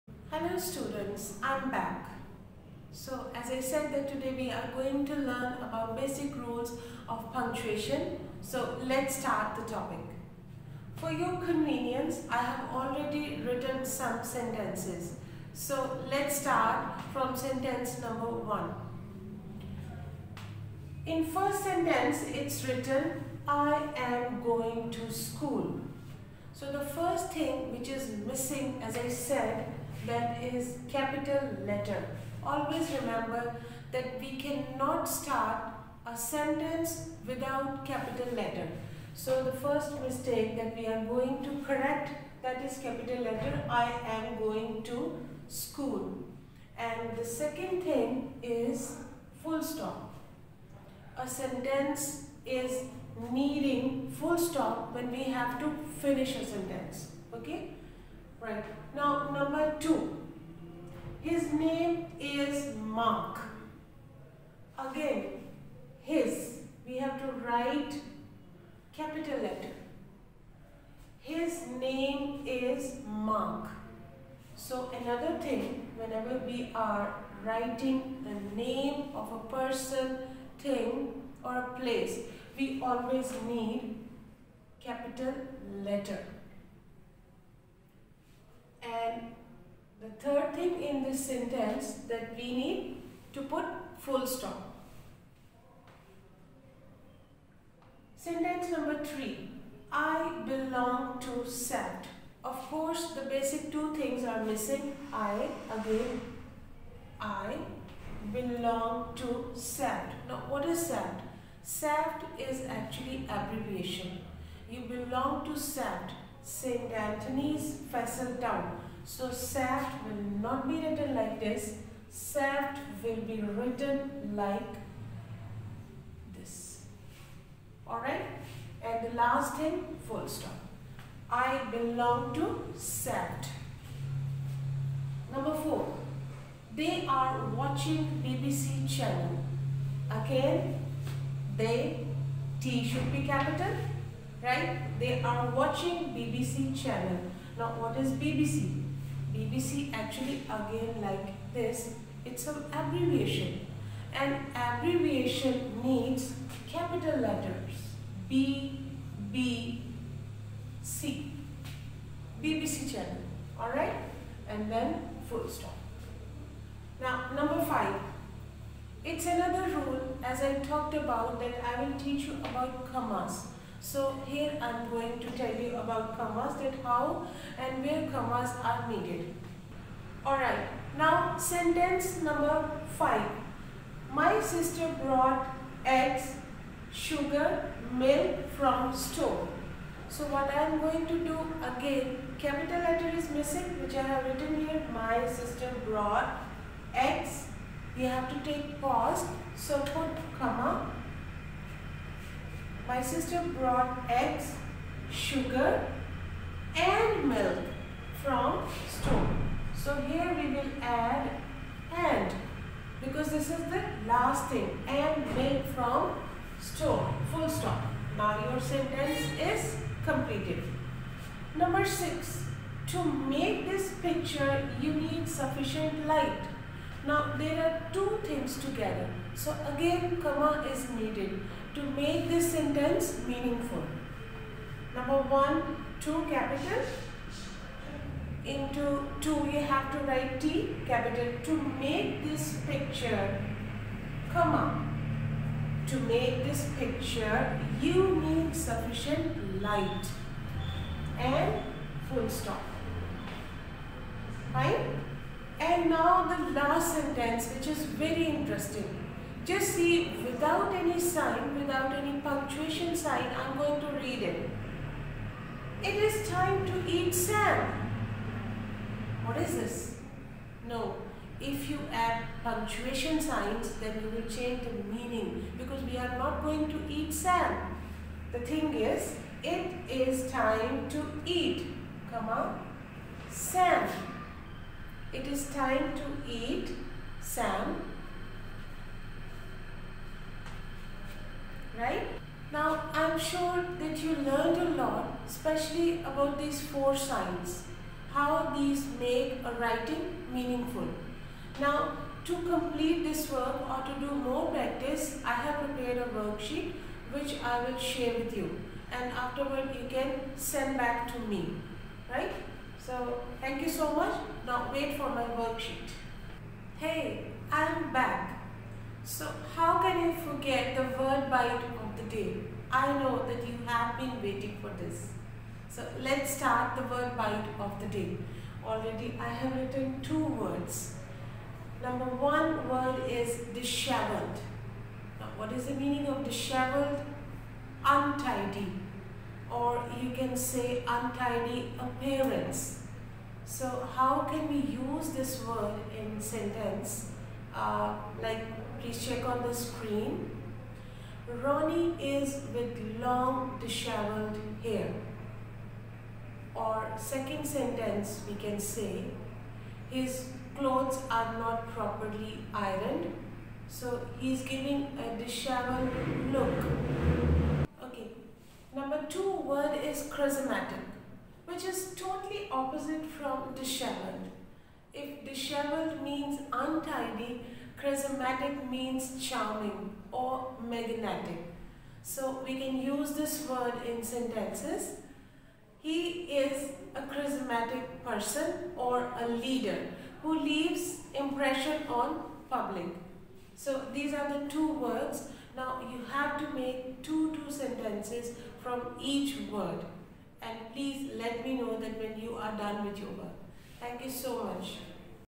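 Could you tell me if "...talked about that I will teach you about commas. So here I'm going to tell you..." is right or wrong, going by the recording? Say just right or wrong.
right.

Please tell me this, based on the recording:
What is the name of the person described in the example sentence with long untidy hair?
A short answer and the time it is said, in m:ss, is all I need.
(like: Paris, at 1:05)
Ronnie, at 5:51.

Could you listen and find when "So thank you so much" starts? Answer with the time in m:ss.
5:12.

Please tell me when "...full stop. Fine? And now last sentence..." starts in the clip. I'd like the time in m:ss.
4:12.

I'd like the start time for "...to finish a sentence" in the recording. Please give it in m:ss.
0:55.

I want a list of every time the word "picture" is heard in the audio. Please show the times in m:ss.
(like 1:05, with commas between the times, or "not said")
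3:44, 4:02, 4:06.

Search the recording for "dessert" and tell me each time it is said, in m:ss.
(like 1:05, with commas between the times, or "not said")
not said.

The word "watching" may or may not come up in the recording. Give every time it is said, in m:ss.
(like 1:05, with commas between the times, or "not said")
2:17, 2:25.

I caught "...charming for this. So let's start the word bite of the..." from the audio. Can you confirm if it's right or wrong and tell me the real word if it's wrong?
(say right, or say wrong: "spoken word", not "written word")
wrong: "waiting", not "charming".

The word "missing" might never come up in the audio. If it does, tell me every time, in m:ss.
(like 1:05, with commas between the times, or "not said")
0:28, 1:44, 3:13.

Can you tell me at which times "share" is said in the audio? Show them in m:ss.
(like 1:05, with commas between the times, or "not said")
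5:07.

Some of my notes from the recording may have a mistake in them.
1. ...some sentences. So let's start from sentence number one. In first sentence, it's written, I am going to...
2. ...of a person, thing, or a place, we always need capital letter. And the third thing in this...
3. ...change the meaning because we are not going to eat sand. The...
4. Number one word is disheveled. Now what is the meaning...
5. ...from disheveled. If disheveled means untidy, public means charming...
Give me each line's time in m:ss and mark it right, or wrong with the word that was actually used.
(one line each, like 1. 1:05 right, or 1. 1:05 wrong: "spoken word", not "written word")
1. 0:13 right
2. 1:19 right
3. 4:34 right
4. 5:31 right
5. 6:13 wrong: "charismatic", not "public".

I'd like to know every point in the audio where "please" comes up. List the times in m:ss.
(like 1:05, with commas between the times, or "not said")
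5:48, 6:40.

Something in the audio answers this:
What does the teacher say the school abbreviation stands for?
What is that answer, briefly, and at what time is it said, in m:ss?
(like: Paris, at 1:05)
St. Anthony's Fessel Town, at 1:56.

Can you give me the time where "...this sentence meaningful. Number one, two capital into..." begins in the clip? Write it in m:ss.
3:52.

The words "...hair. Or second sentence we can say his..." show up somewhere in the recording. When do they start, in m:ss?
5:54.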